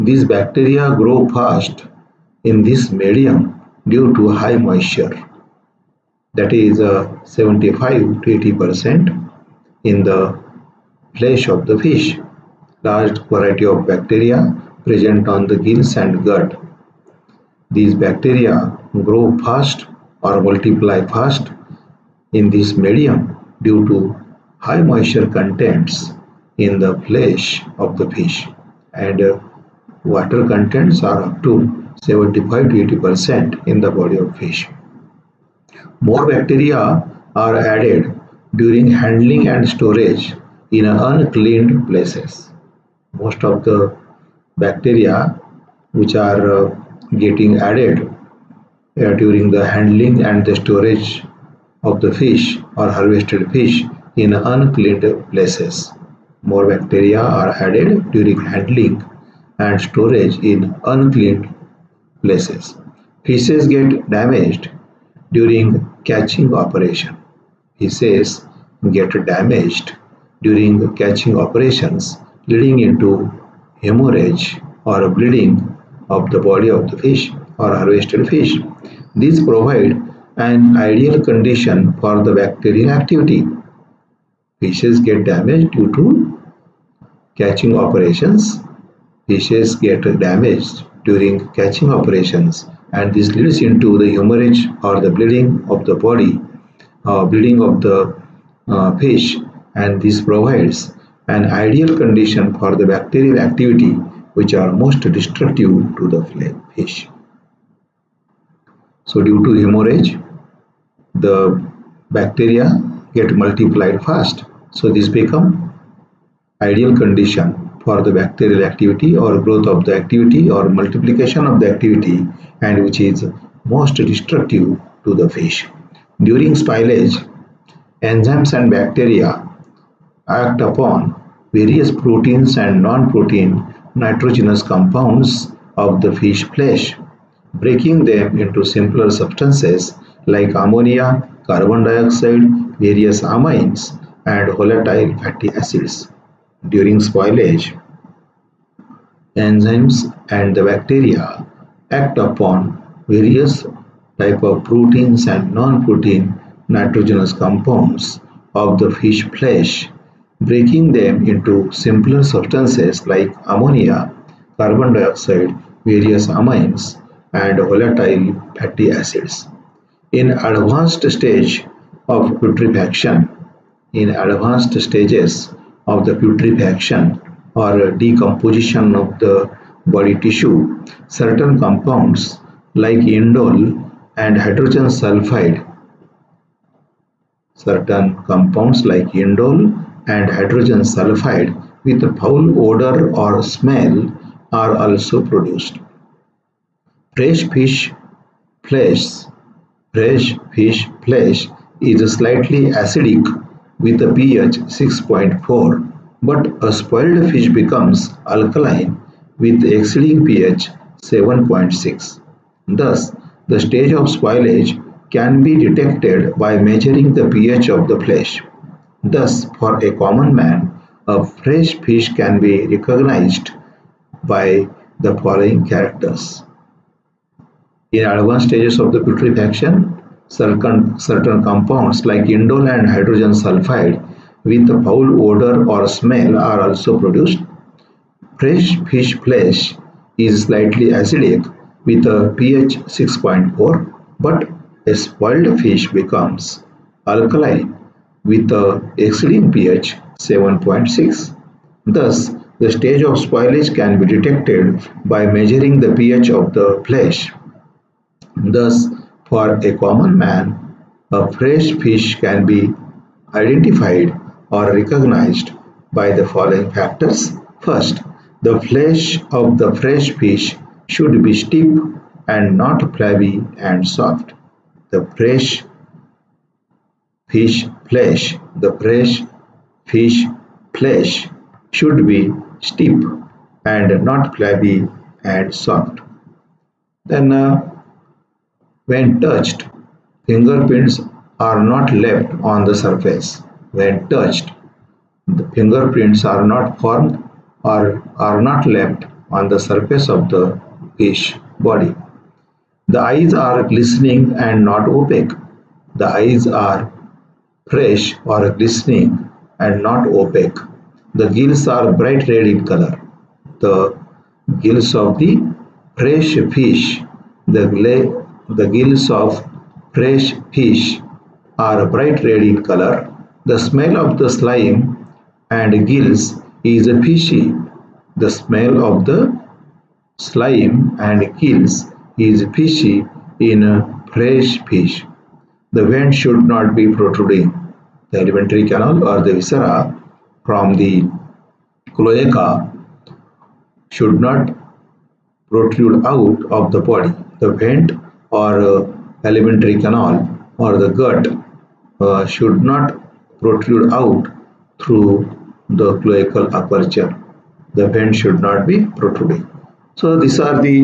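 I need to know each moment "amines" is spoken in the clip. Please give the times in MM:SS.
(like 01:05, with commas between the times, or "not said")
02:23, 02:46.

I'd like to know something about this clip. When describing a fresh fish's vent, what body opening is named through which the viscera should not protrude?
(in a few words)
Cloaca.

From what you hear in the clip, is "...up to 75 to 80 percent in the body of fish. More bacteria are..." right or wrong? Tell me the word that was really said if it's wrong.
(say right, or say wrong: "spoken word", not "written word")
right.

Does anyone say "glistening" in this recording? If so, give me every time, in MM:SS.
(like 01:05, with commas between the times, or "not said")
05:03, 05:08.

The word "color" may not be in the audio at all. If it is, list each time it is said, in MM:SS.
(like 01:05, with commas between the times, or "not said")
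05:12, 05:22.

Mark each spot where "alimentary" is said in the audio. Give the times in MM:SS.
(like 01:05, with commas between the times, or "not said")
05:38, 05:49.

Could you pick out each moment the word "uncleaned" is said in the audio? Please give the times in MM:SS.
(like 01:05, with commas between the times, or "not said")
00:40, 00:54, 01:00.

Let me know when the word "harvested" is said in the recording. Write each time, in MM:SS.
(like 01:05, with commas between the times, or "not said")
00:52, 01:17.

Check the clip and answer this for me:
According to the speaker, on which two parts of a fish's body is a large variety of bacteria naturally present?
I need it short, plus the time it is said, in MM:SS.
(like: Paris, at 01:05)
Gills and gut, at 00:15.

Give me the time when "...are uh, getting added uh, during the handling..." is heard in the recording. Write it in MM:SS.
00:46.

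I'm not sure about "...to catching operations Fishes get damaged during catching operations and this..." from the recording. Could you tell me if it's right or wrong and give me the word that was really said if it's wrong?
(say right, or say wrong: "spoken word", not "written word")
right.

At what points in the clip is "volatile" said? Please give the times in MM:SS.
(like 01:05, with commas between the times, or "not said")
02:24, 02:47.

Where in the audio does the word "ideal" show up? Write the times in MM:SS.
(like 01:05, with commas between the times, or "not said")
01:20, 01:41, 01:56.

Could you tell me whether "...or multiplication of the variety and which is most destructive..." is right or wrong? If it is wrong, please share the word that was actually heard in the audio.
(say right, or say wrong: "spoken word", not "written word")
wrong: "activity", not "variety".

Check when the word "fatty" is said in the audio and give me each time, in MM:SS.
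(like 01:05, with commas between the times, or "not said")
02:25, 02:48.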